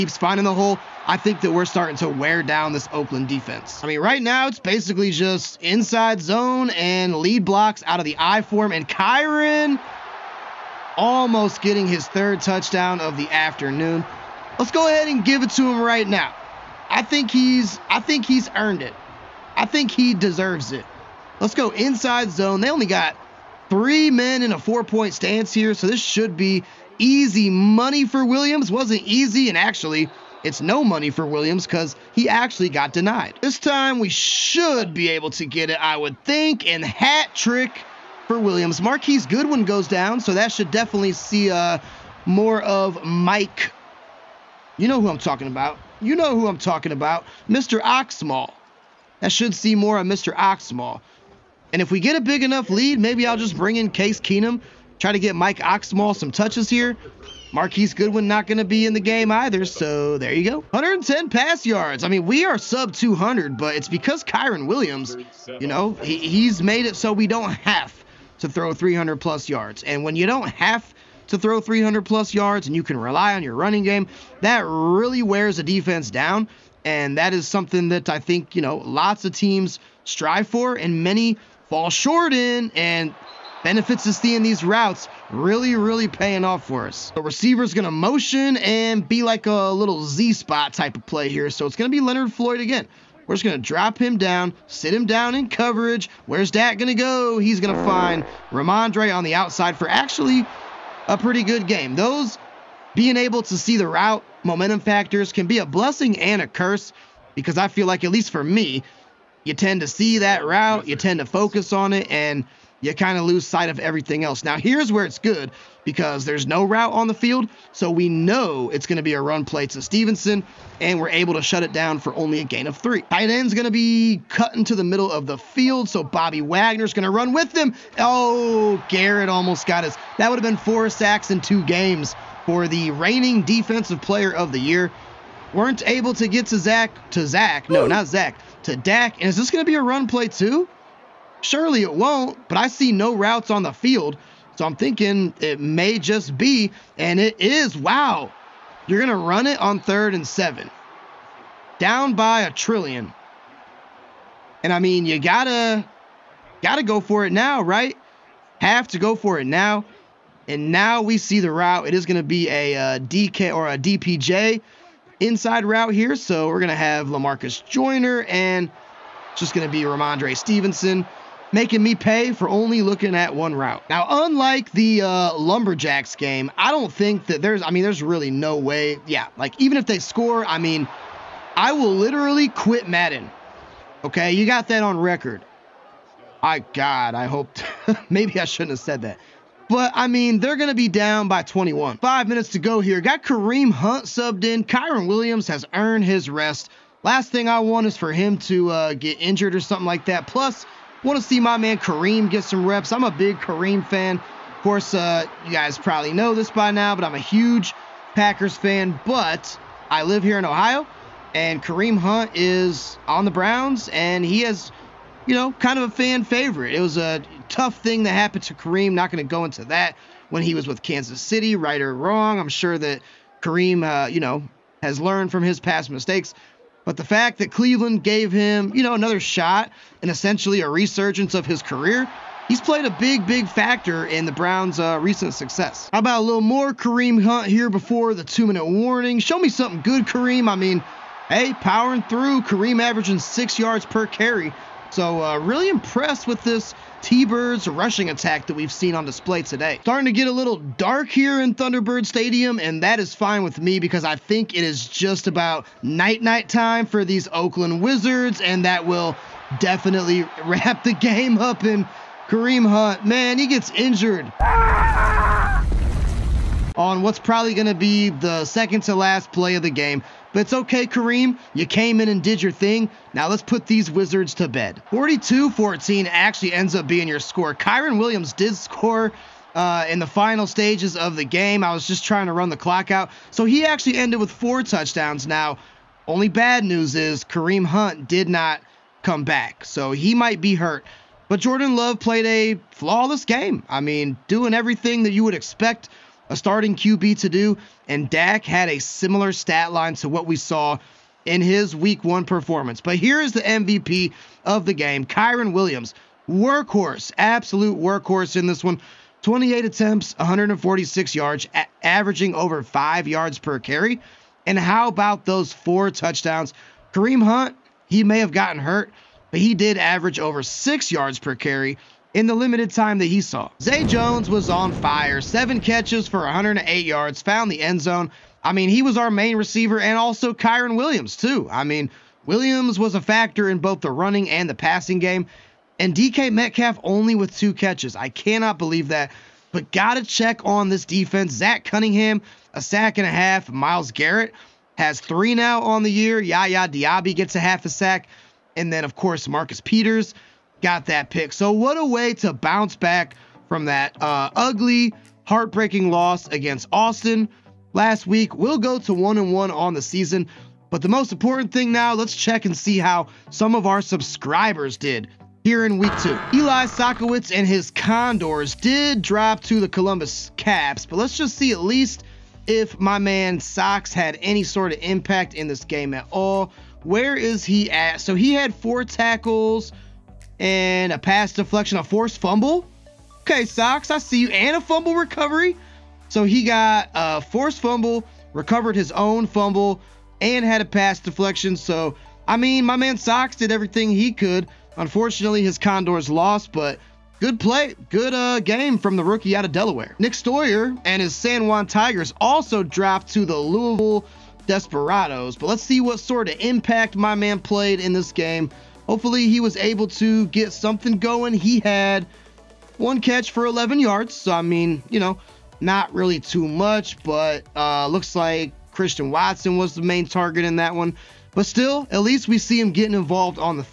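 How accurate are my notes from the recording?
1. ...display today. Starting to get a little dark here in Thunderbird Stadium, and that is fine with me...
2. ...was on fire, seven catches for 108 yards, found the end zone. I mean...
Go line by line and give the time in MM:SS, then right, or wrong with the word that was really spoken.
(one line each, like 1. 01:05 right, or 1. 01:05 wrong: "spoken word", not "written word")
1. 04:09 right
2. 05:24 right.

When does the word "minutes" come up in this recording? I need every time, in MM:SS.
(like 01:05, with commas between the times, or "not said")
03:12, 03:58.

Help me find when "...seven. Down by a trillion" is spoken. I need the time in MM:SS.
02:30.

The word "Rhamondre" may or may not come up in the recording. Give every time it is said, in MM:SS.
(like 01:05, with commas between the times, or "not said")
01:38, 02:49.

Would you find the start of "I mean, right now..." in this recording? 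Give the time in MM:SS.
00:03.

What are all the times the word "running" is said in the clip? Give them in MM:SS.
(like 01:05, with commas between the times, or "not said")
01:13, 05:33.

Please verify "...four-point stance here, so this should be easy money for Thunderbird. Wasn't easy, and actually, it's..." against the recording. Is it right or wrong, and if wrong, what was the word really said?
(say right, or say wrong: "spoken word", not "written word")
wrong: "Williams", not "Thunderbird".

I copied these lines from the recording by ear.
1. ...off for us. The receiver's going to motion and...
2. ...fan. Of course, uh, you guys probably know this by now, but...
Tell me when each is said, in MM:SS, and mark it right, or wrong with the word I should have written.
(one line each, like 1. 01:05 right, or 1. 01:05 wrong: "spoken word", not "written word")
1. 01:26 right
2. 03:23 right.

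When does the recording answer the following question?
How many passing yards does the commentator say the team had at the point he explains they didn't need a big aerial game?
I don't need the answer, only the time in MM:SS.
01:00.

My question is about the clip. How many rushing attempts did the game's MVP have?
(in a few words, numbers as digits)
28.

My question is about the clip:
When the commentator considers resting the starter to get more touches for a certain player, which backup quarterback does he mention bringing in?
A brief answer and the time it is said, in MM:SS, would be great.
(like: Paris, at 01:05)
Case Keenum, at 00:53.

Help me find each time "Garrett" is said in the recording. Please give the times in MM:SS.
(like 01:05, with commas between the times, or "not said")
02:08, 05:43.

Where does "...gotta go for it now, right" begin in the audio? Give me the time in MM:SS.
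02:36.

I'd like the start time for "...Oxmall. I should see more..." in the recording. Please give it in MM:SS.
00:47.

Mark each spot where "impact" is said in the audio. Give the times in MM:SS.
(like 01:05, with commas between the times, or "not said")
06:14, 06:46.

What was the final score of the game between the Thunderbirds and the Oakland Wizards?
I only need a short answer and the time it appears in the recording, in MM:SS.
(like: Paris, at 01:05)
42-14, at 04:34.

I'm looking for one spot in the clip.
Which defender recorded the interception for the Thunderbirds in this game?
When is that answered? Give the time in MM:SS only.
05:49.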